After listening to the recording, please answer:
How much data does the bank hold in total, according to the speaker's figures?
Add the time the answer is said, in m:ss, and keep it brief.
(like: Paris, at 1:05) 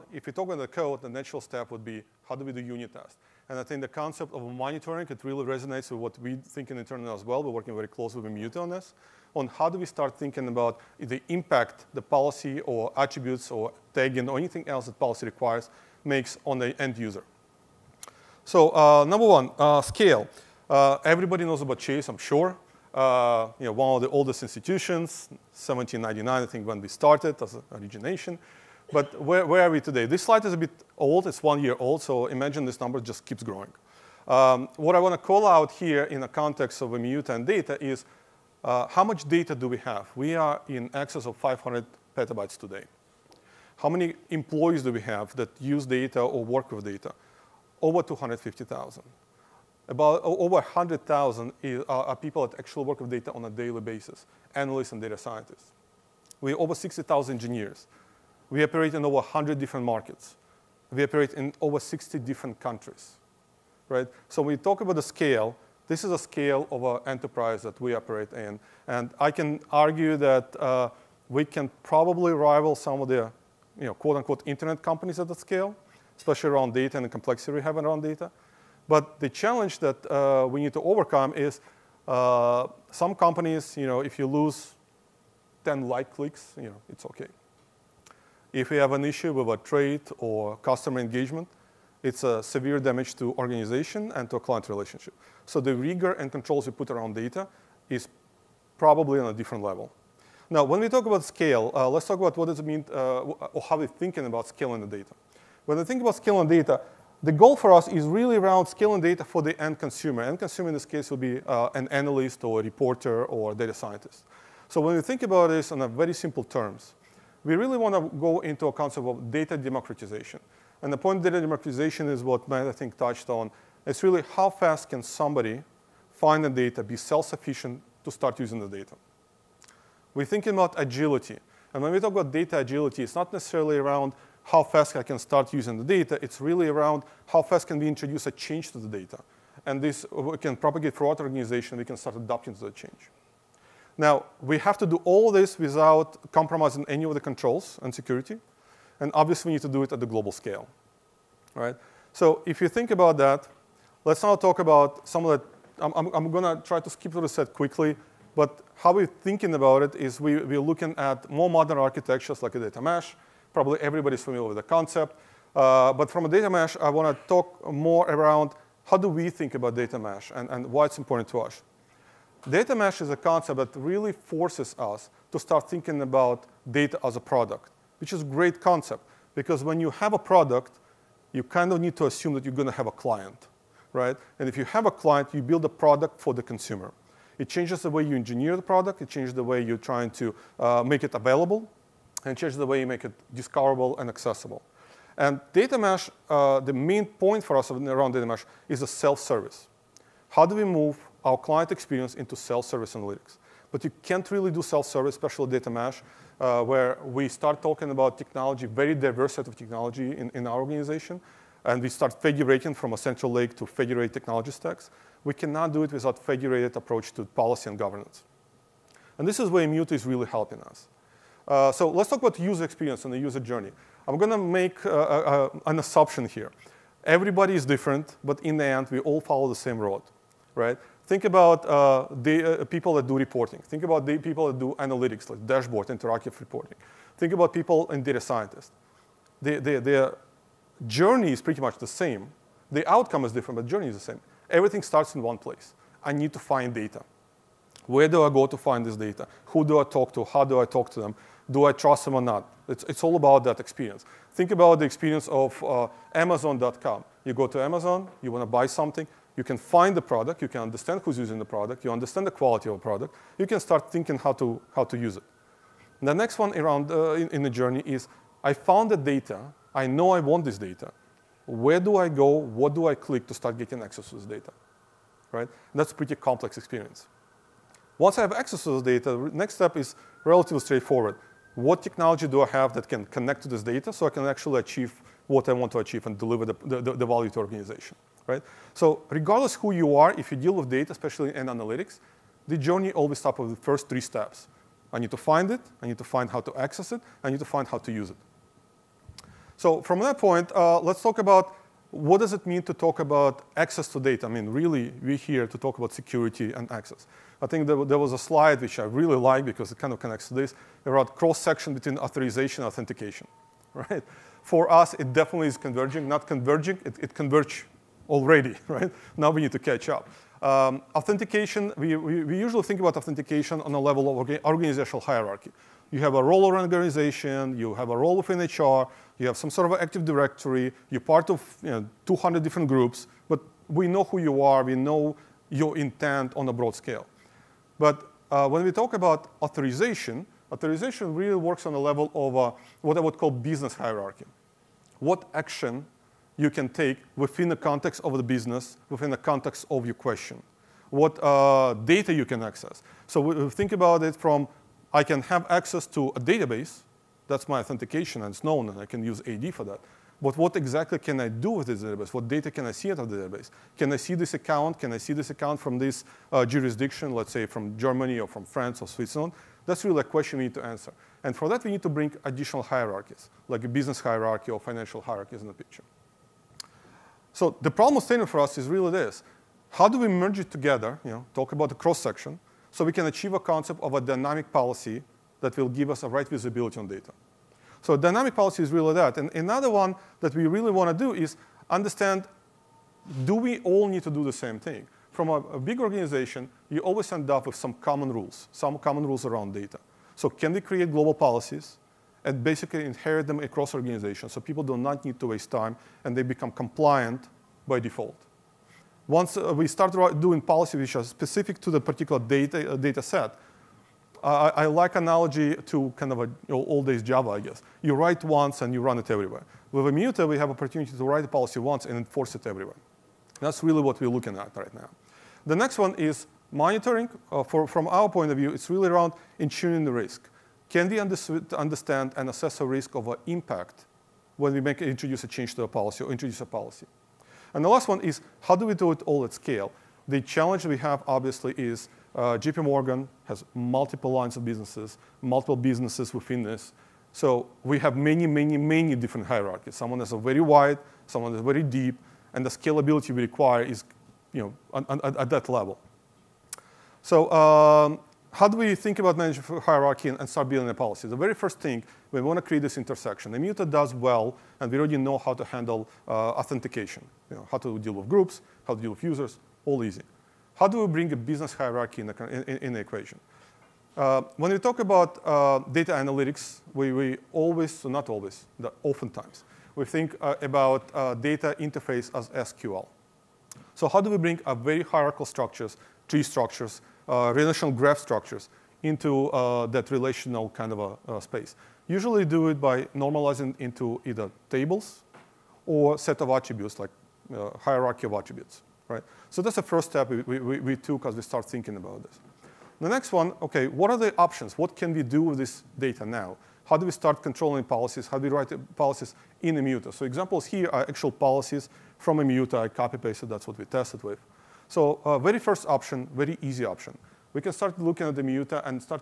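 over 500 petabytes, at 0:41.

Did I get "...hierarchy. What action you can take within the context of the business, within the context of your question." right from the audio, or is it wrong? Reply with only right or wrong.
right.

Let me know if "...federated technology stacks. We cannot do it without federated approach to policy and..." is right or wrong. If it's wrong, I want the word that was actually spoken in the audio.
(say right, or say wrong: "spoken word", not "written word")
right.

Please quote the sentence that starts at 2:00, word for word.
And the point of data democratization is what Matt, I think, touched on.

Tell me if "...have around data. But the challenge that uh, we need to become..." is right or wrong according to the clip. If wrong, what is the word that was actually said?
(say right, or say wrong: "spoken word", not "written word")
wrong: "overcome", not "become".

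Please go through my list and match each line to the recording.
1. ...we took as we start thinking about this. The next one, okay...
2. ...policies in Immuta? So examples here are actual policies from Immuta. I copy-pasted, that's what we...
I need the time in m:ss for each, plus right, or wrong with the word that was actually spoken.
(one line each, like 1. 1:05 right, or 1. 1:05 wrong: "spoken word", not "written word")
1. 8:20 right
2. 8:28 right.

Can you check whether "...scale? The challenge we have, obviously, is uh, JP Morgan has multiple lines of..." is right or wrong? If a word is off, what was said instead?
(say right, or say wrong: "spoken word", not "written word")
right.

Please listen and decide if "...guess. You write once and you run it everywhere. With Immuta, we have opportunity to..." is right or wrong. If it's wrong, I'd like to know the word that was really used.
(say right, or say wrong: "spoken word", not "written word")
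right.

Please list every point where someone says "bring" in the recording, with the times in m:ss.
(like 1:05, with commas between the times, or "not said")
6:11, 7:50, 8:04.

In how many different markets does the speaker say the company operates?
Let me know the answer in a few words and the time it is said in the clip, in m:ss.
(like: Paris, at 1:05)
over 100, at 0:59.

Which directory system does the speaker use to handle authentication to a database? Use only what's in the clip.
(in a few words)
AD.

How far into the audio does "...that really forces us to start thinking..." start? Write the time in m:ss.
2:53.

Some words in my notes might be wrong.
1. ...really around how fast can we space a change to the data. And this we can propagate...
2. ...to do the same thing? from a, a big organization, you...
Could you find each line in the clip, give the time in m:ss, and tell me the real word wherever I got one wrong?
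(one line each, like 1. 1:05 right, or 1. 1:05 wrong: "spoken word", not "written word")
1. 2:16 wrong: "introduce", not "space"
2. 6:34 right.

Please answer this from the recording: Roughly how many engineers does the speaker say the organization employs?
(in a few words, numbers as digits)
over 60,000.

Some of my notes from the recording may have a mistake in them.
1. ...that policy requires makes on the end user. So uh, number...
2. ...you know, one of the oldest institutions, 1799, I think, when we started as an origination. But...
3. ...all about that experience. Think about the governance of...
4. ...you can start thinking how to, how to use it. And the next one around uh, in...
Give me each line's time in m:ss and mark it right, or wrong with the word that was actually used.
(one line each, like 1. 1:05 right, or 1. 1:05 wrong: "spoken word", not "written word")
1. 0:14 right
2. 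0:23 right
3. 4:13 wrong: "experience", not "governance"
4. 4:23 right.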